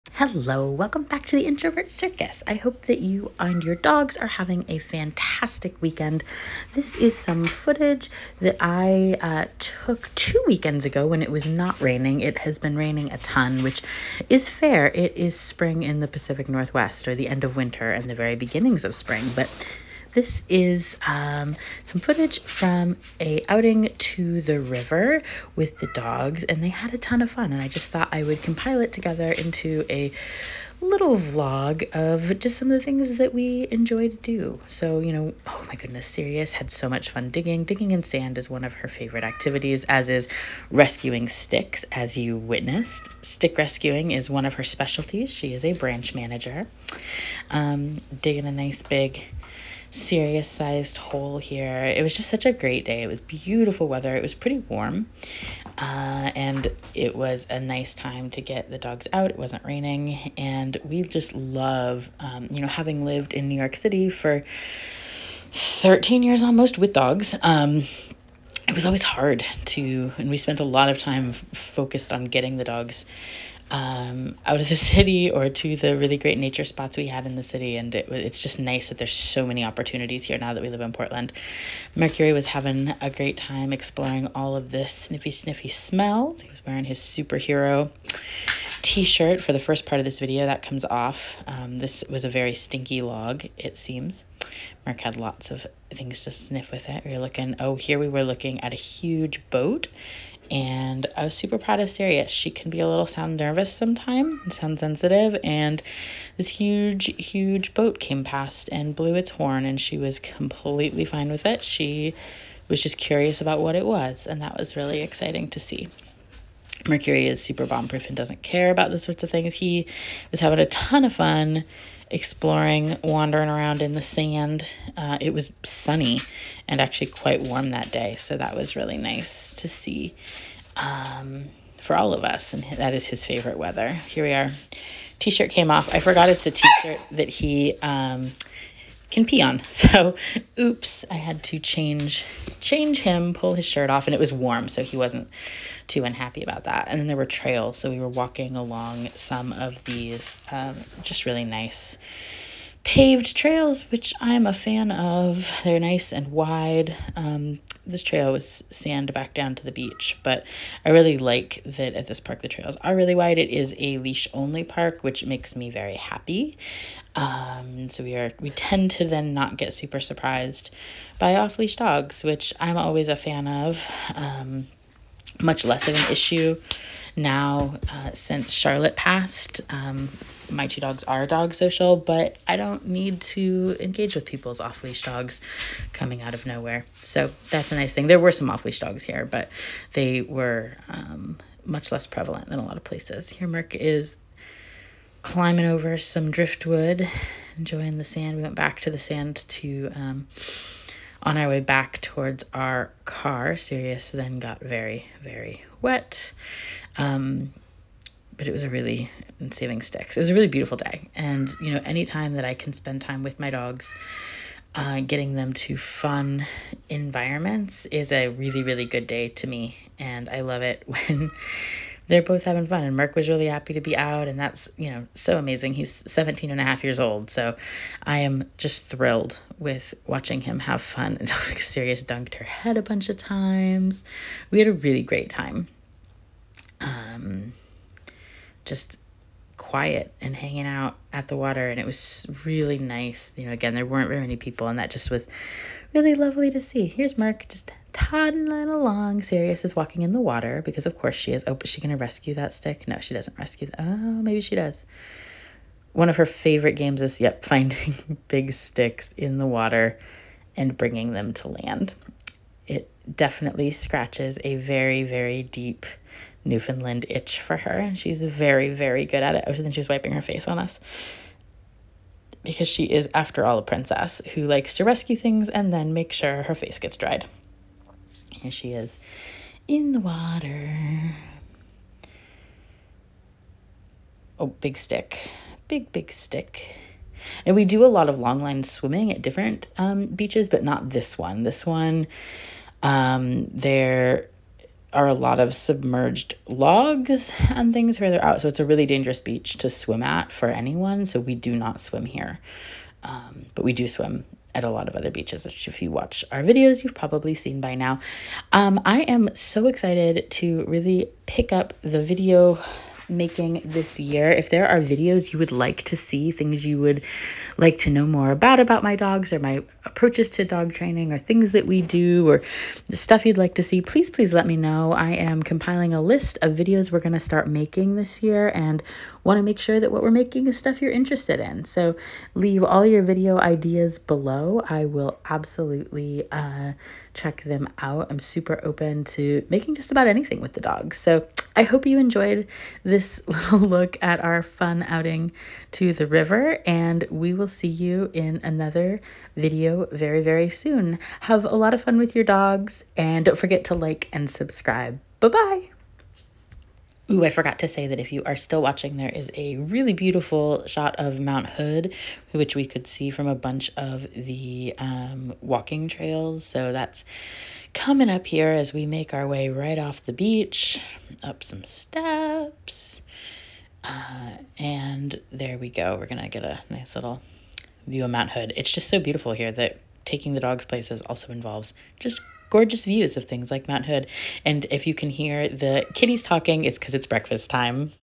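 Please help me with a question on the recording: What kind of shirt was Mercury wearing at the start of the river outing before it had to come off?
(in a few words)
superhero t-shirt.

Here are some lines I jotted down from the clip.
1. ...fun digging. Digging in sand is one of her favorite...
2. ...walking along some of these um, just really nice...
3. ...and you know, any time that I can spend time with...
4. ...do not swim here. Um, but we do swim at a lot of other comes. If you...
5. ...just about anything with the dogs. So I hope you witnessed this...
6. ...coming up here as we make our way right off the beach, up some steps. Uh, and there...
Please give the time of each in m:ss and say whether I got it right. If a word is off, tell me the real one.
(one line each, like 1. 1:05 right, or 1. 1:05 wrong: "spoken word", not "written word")
1. 0:37 right
2. 2:28 right
3. 3:31 right
4. 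5:01 wrong: "beaches", not "comes"
5. 5:39 wrong: "enjoyed", not "witnessed"
6. 6:07 right.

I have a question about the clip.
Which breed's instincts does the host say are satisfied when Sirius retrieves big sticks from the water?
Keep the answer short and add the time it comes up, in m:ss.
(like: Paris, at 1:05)
Newfoundland, at 4:26.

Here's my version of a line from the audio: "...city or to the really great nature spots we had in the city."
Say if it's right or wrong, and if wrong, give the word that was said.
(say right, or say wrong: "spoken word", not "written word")
right.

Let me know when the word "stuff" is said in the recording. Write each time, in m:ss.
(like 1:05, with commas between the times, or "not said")
5:22, 5:30.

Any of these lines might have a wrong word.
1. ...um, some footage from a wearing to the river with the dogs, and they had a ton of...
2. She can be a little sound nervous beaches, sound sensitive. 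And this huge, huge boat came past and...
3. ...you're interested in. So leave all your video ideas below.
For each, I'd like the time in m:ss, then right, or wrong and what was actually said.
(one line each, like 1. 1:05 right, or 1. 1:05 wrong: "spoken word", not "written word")
1. 0:21 wrong: "outing", not "wearing"
2. 1:42 wrong: "sometimes", not "beaches"
3. 5:30 right.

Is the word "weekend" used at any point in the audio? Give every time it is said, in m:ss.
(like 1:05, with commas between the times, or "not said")
0:05, 0:10.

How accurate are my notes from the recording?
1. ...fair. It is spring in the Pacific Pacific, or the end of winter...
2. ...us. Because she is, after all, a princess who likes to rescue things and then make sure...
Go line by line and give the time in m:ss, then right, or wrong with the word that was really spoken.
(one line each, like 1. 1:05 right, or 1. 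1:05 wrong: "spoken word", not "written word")
1. 0:14 wrong: "Northwest", not "Pacific"
2. 4:30 right.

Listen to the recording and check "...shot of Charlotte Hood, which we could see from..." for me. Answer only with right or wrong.
wrong.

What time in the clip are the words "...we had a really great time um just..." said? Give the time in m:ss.
3:54.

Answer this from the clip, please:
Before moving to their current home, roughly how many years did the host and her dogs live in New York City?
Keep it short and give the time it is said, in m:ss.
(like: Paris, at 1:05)
13, at 1:05.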